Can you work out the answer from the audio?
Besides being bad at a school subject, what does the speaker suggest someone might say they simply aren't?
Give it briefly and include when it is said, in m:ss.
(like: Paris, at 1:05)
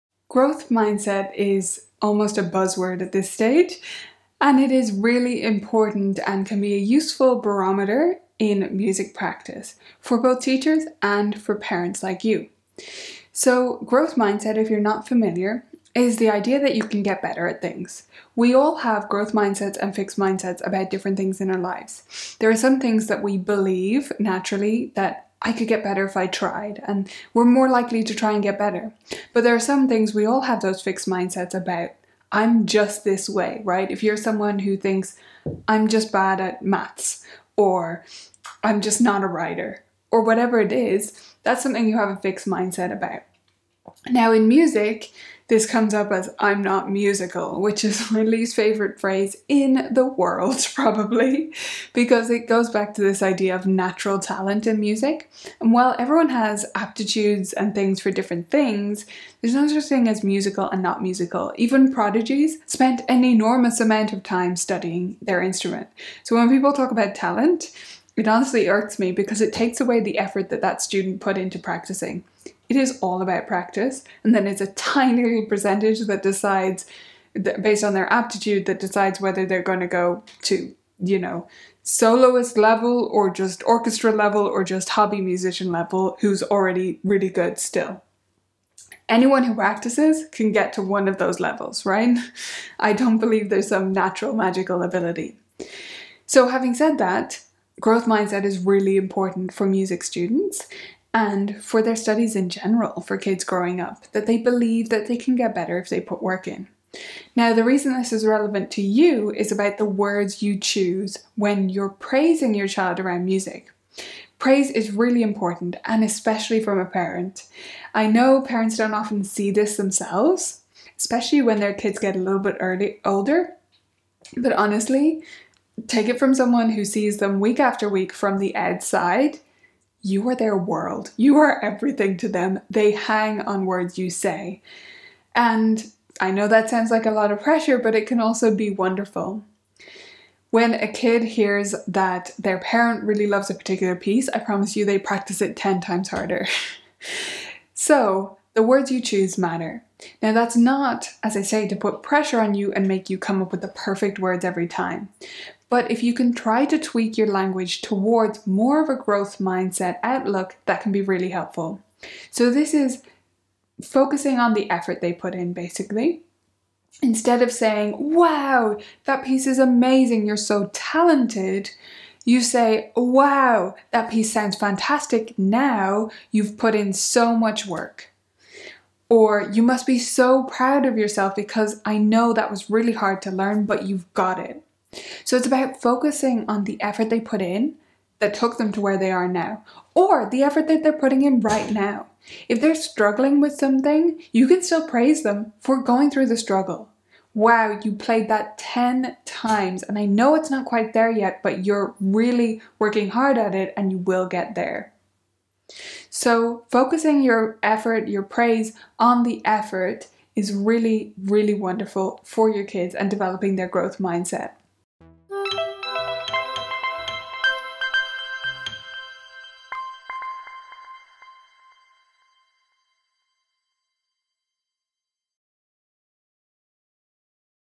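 a writer, at 0:39.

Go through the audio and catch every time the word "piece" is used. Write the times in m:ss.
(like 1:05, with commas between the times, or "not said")
2:23, 2:49, 2:54.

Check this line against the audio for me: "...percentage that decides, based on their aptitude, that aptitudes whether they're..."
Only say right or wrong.
wrong.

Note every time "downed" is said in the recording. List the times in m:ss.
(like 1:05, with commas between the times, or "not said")
not said.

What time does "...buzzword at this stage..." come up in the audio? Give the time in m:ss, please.
0:02.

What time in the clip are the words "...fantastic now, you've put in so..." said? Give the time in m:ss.
2:54.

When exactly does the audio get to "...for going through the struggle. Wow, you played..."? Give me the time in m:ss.
3:15.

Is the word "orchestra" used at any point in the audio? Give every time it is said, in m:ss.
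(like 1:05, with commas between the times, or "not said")
1:23.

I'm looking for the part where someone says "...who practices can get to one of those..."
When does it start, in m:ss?
1:29.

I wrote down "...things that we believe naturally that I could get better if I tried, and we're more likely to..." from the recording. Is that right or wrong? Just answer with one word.
right.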